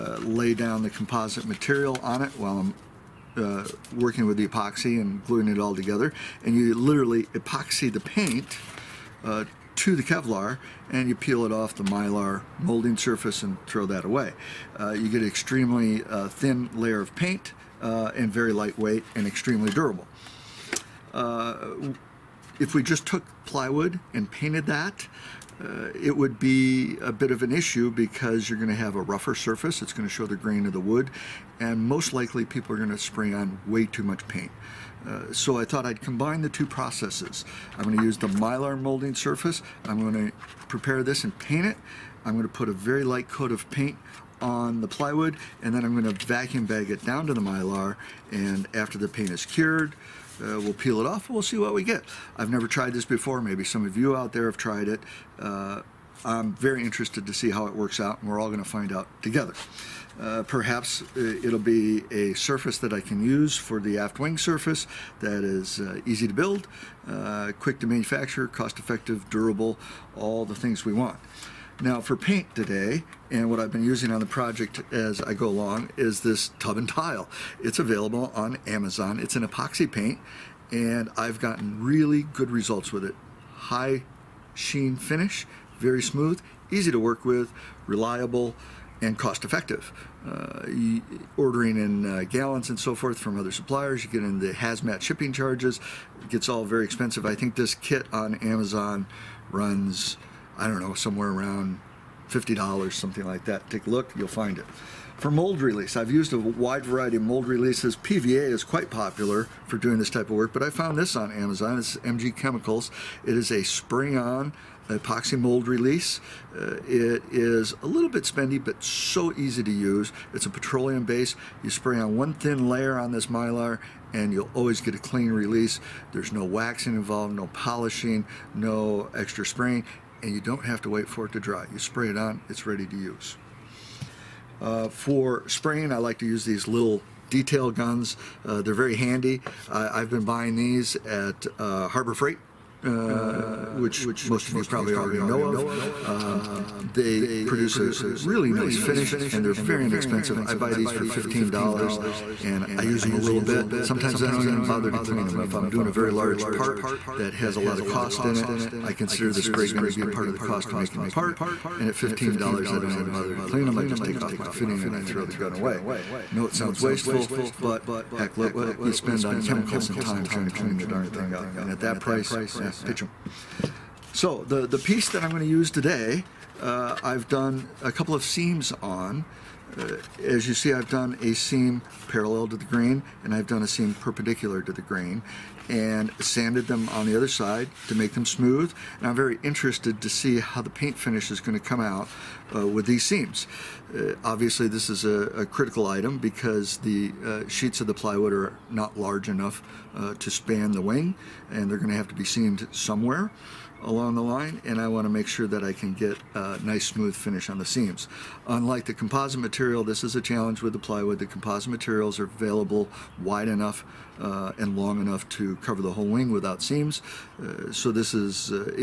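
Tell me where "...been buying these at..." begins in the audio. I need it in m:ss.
2:20.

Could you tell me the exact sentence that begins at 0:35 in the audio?
Uh, so I thought I'd combine the two processes.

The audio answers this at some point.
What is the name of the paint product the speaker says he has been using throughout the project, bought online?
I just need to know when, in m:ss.
1:16.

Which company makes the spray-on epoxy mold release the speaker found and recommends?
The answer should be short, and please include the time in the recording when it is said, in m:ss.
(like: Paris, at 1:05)
MG Chemicals, at 1:51.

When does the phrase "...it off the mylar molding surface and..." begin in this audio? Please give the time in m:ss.
0:11.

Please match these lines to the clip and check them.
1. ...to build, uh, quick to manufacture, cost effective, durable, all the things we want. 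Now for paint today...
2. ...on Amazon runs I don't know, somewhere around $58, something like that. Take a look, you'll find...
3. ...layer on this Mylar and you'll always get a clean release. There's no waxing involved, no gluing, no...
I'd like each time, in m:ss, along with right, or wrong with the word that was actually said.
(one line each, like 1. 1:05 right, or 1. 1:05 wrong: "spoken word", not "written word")
1. 1:06 right
2. 1:38 wrong: "50", not "58"
3. 2:02 wrong: "polishing", not "gluing".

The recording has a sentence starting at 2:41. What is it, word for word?
And at $15, I don't even bother to clean them.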